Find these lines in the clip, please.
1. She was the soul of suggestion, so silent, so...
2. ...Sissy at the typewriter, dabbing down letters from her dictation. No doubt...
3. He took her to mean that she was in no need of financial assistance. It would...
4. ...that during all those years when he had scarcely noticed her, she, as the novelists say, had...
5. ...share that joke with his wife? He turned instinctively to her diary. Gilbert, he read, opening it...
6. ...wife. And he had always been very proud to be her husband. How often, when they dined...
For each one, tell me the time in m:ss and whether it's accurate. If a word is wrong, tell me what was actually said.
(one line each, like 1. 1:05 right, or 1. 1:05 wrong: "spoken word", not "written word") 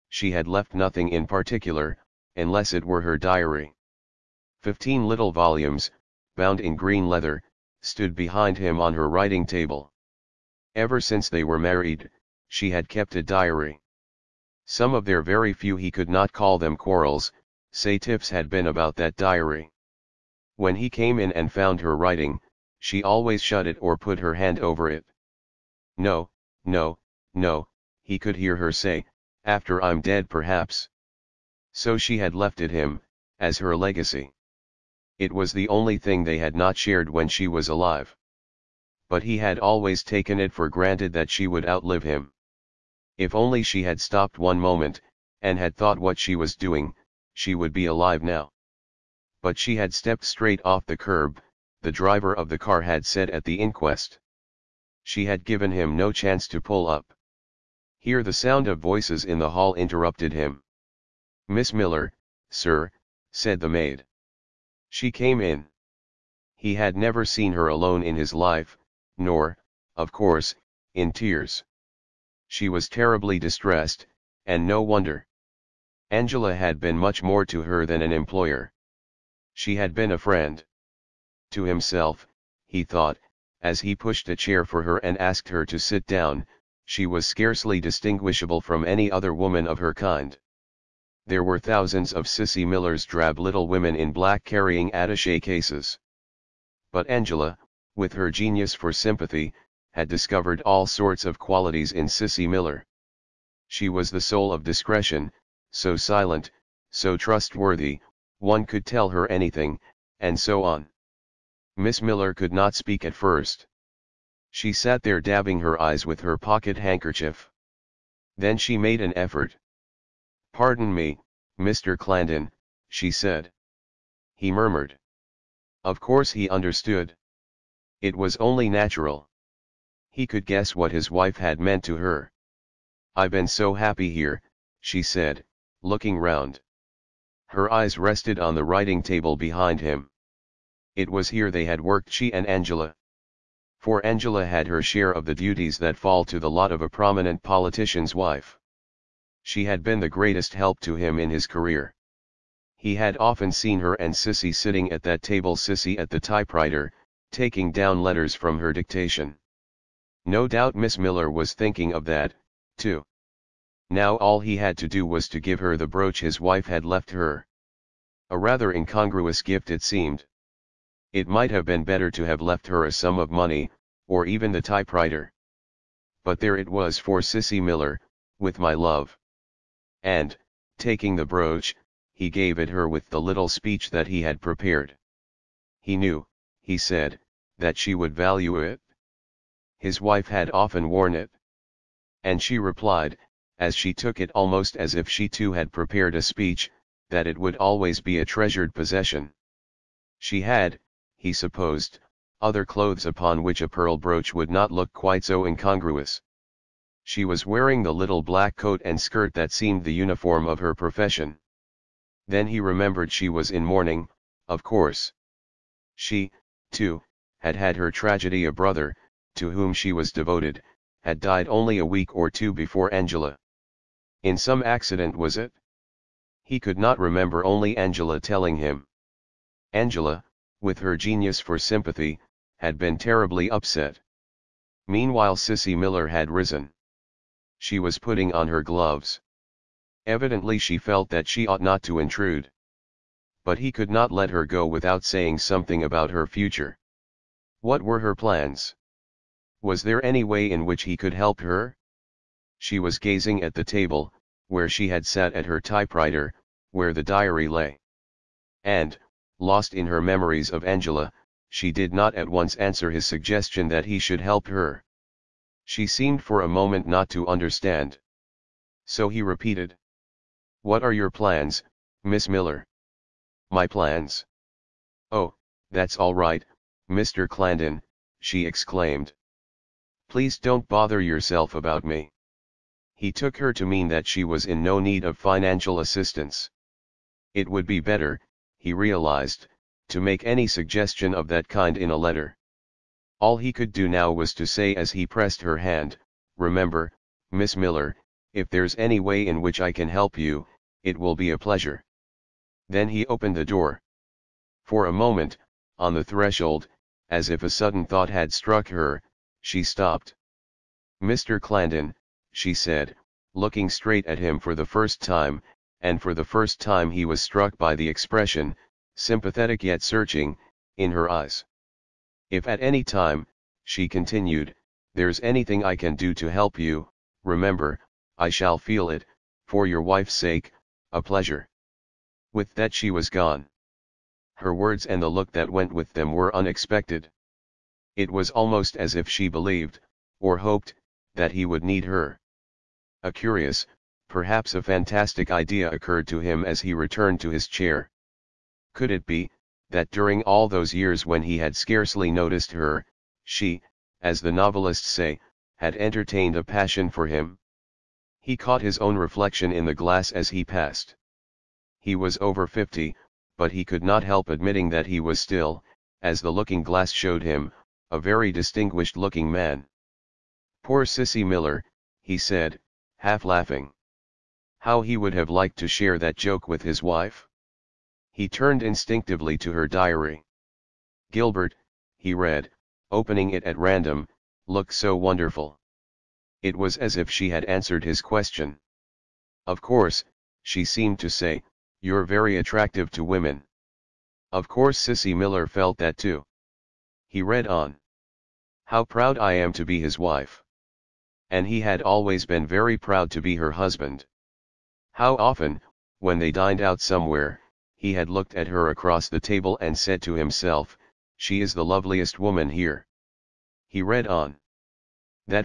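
1. 1:43 wrong: "discretion", not "suggestion"
2. 2:35 wrong: "taking", not "dabbing"
3. 4:42 right
4. 5:49 right
5. 6:15 right
6. 6:39 right.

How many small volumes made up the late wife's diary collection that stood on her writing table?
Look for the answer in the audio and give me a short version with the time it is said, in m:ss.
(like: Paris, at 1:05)
15, at 0:04.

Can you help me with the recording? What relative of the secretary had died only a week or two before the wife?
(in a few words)
a brother.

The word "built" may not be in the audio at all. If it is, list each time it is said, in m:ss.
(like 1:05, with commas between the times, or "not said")
not said.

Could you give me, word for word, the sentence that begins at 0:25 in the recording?
No, no, no, he could hear her say, after I'm dead perhaps.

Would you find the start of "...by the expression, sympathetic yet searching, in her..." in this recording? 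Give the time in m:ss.
5:17.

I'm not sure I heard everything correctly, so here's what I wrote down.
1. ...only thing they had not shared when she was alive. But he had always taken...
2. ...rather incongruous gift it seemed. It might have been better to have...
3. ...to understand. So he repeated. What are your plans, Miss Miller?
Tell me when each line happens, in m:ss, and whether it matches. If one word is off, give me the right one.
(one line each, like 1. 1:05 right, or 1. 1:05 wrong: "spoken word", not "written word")
1. 0:35 right
2. 2:48 right
3. 4:27 right.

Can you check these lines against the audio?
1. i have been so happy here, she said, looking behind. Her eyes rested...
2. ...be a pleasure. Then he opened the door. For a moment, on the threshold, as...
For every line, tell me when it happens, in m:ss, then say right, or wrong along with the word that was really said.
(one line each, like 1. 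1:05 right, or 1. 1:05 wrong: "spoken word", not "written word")
1. 2:13 wrong: "round", not "behind"
2. 5:01 right.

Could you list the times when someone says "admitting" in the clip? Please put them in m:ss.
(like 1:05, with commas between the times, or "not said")
6:04.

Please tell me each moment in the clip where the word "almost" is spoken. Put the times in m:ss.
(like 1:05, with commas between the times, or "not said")
3:14, 5:38.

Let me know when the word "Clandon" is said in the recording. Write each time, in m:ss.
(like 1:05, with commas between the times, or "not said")
2:01, 4:37, 5:11.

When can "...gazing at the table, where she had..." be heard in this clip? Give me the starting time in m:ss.
4:12.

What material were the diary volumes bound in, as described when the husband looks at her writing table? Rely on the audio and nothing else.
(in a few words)
green leather.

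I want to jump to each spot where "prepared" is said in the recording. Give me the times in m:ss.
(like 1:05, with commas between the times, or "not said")
3:04, 3:15.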